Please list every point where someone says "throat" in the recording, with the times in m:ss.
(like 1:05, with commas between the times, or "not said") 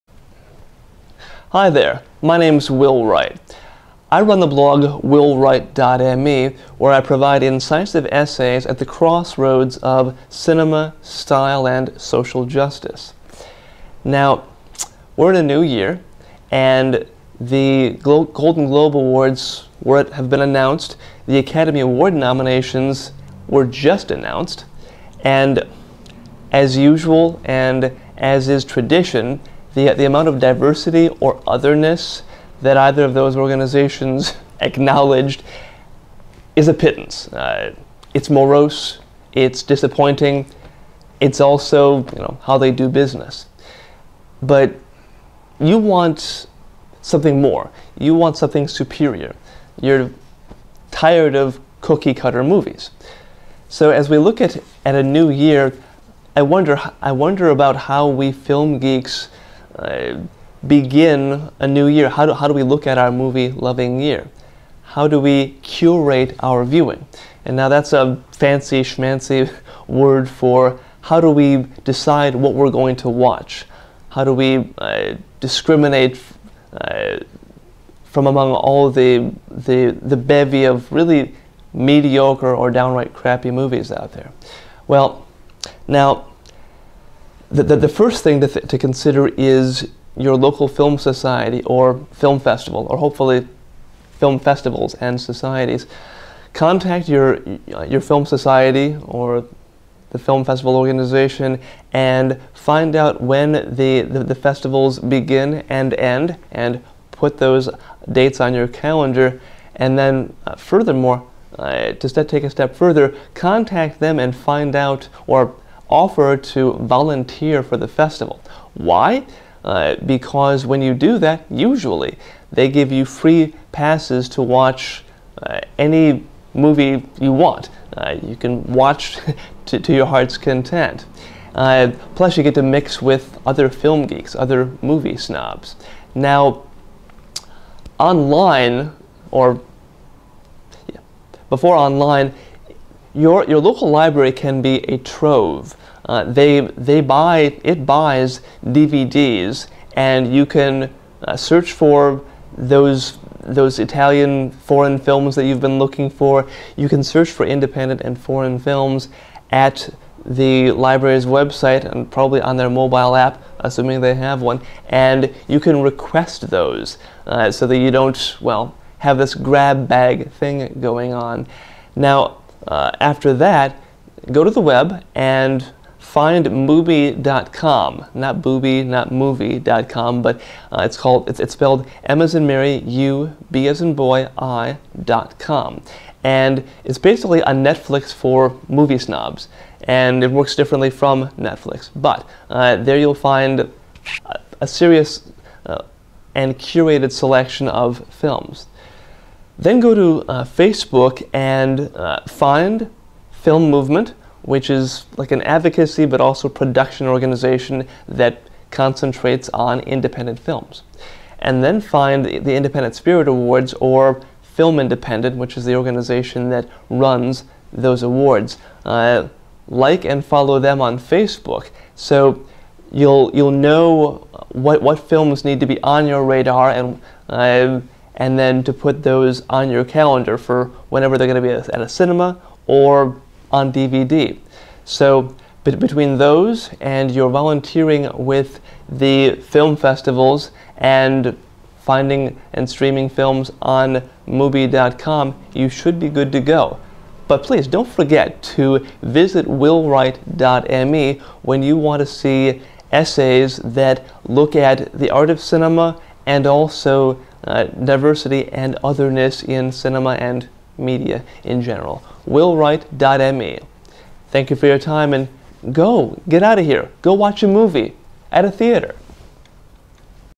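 not said.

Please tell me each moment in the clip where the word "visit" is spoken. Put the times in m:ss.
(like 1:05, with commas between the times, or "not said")
4:09.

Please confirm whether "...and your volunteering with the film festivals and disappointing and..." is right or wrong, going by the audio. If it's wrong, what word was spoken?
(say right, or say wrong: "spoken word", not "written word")
wrong: "finding", not "disappointing".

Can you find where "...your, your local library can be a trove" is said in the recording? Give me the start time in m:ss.
2:23.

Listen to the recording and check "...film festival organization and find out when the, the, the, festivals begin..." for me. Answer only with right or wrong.
right.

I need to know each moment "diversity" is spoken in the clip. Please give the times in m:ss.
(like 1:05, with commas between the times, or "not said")
0:30, 4:17.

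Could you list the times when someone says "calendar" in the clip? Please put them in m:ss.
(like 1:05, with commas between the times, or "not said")
1:48, 3:49.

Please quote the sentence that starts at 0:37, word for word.
Uh, it's morose, it's disappointing, it's also you know, how they do business.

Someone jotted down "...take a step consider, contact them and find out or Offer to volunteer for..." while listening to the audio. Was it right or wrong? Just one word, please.
wrong.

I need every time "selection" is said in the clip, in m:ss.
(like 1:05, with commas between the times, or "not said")
3:17.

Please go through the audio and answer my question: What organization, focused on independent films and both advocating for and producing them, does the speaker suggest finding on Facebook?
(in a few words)
Film Movement.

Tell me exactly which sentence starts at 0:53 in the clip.
So as we look at, at a new year, I wonder, I wonder about how we film geeks begin a new year?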